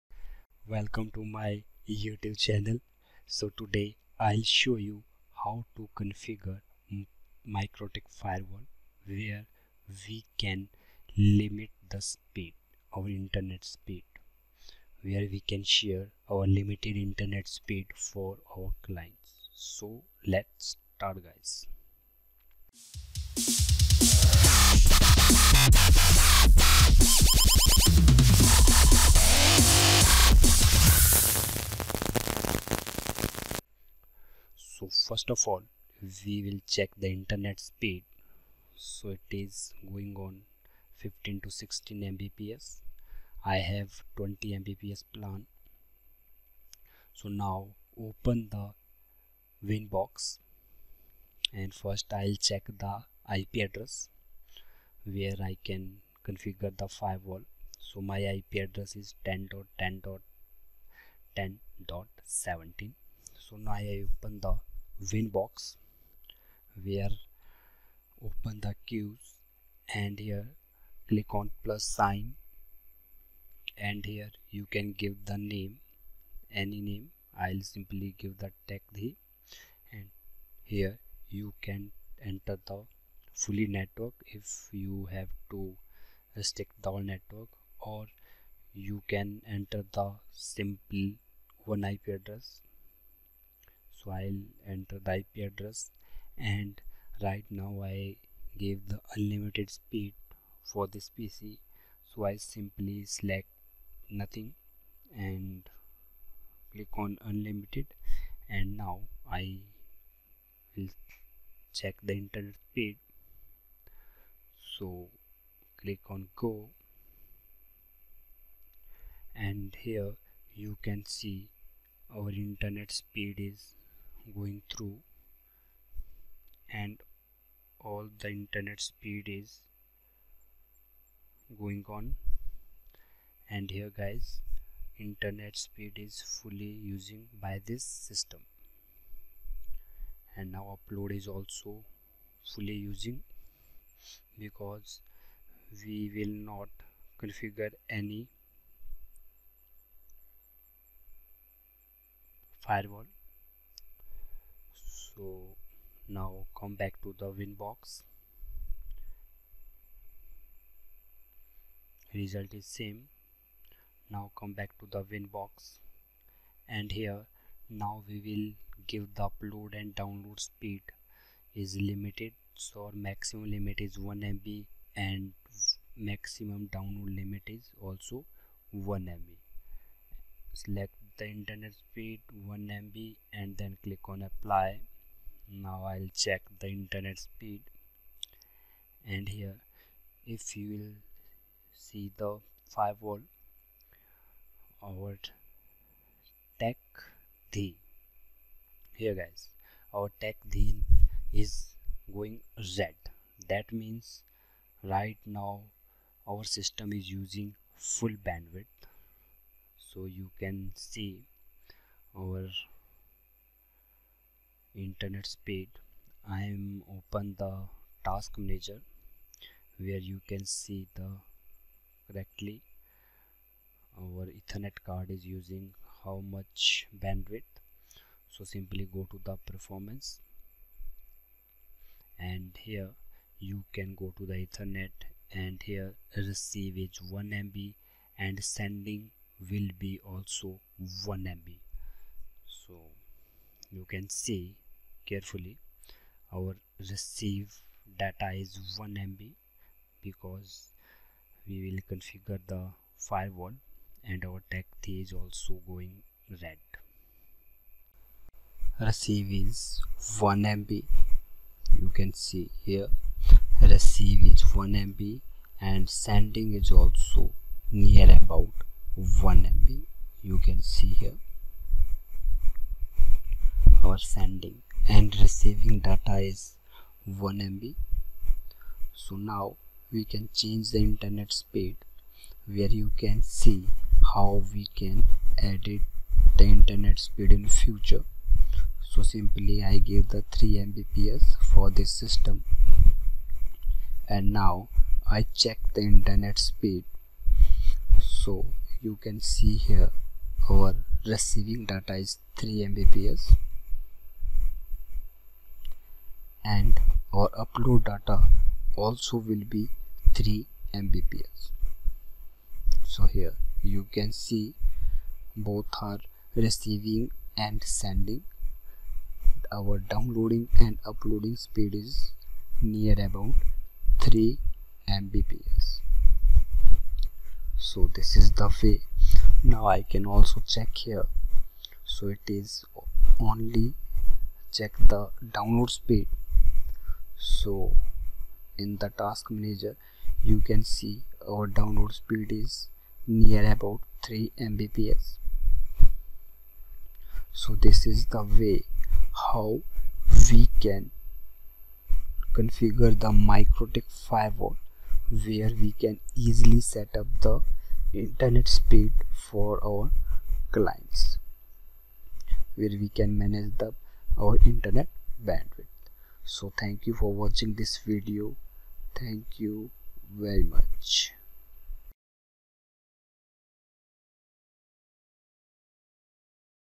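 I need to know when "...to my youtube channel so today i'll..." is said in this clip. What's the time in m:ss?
0:01.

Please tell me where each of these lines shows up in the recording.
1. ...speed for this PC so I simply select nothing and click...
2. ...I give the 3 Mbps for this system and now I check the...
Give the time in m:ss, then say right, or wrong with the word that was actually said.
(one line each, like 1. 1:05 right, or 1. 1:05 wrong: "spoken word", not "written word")
1. 1:39 right
2. 4:49 right.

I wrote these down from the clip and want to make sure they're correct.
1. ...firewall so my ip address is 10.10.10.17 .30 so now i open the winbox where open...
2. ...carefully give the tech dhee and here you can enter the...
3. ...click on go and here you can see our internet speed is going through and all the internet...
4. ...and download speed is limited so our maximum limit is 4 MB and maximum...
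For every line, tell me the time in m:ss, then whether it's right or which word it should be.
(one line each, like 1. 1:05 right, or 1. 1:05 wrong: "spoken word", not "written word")
1. 0:56 wrong: "10", not "30"
2. 1:17 wrong: "simply", not "carefully"
3. 1:55 right
4. 2:49 wrong: "1", not "4".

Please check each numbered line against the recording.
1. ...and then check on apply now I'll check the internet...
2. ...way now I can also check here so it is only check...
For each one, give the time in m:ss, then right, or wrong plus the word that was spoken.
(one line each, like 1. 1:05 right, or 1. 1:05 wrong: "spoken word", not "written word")
1. 3:03 wrong: "click", not "check"
2. 5:28 right.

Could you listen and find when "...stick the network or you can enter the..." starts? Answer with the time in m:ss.
1:26.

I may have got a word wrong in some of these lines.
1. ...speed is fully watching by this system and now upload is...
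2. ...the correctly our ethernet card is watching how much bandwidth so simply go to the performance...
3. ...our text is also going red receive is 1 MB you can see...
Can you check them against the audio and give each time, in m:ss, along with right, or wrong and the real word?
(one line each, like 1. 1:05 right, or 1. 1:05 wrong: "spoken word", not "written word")
1. 2:15 wrong: "using", not "watching"
2. 3:40 wrong: "using", not "watching"
3. 4:14 right.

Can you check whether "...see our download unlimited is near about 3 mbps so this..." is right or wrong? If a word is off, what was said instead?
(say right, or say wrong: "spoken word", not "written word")
wrong: "speed", not "unlimited".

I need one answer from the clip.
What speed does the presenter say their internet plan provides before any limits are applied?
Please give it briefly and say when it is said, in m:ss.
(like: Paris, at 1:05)
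20 Mbps, at 0:44.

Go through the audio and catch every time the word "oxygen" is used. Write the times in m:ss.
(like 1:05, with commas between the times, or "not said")
not said.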